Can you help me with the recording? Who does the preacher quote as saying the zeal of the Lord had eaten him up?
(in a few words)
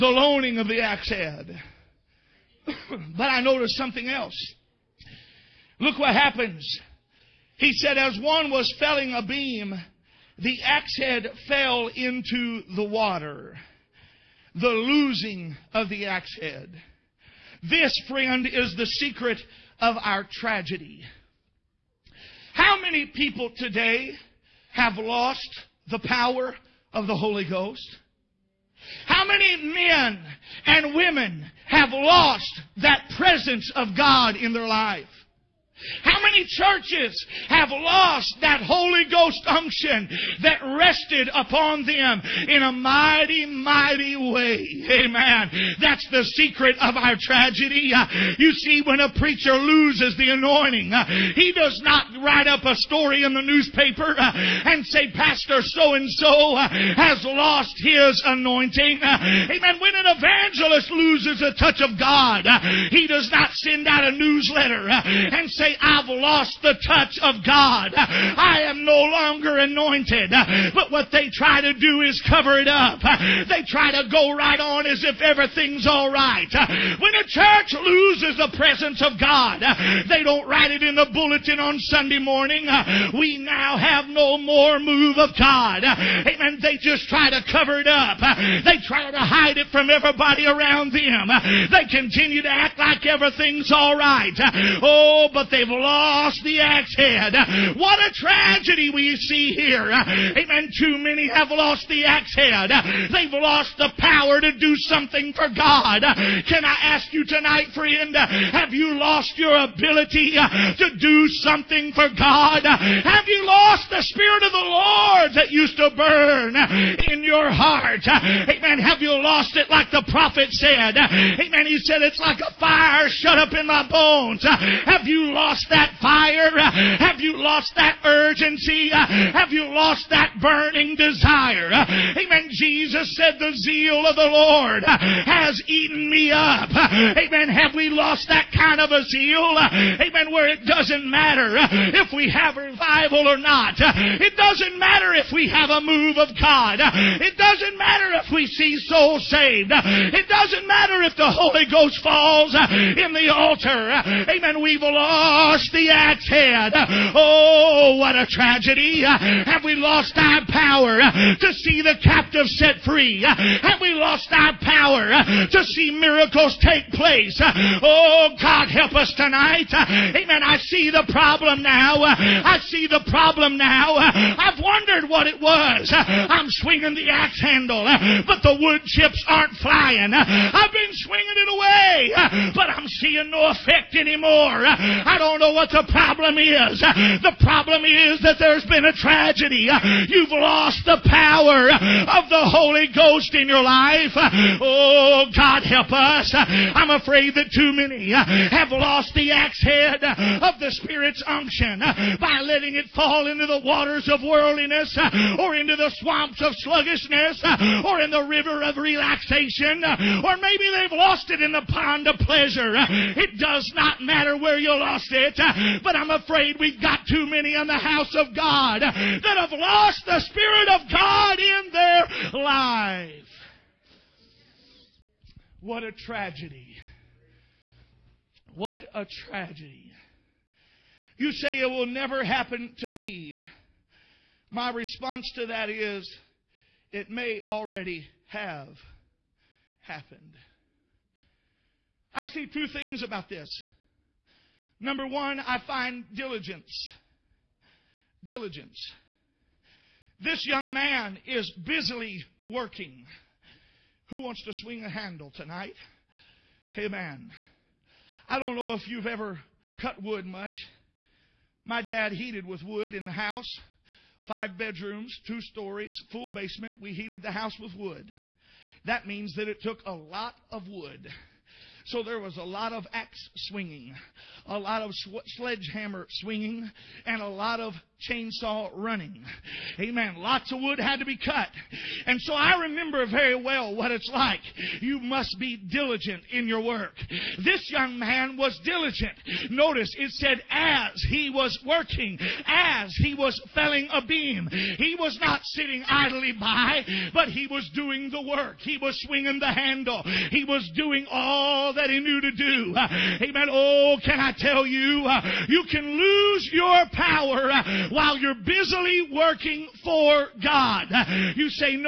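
Jesus.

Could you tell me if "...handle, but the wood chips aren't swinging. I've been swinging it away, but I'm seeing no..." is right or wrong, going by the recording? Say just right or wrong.
wrong.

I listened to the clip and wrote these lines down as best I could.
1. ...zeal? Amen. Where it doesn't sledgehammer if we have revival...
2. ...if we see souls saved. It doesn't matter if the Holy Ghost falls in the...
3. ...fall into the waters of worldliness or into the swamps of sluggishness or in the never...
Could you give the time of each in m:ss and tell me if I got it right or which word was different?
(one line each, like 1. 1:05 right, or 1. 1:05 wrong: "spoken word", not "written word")
1. 2:19 wrong: "matter", not "sledgehammer"
2. 2:28 right
3. 3:22 wrong: "river", not "never".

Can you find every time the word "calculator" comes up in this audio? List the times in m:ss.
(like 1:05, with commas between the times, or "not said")
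not said.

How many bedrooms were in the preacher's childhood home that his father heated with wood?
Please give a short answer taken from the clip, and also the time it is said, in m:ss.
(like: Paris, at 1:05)
5, at 4:24.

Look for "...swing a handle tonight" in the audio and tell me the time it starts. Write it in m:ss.
4:14.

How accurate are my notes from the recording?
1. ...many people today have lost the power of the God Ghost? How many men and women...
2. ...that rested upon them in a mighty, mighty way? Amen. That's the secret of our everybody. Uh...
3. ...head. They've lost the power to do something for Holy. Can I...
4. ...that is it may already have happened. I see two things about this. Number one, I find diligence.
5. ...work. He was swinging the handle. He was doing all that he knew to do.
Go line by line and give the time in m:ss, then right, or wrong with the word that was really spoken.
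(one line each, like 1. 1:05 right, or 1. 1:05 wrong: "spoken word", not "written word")
1. 0:22 wrong: "Holy", not "God"
2. 0:40 wrong: "tragedy", not "everybody"
3. 1:42 wrong: "God", not "Holy"
4. 3:55 right
5. 4:58 right.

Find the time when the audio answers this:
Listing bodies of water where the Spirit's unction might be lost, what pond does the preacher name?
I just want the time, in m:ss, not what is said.
3:31.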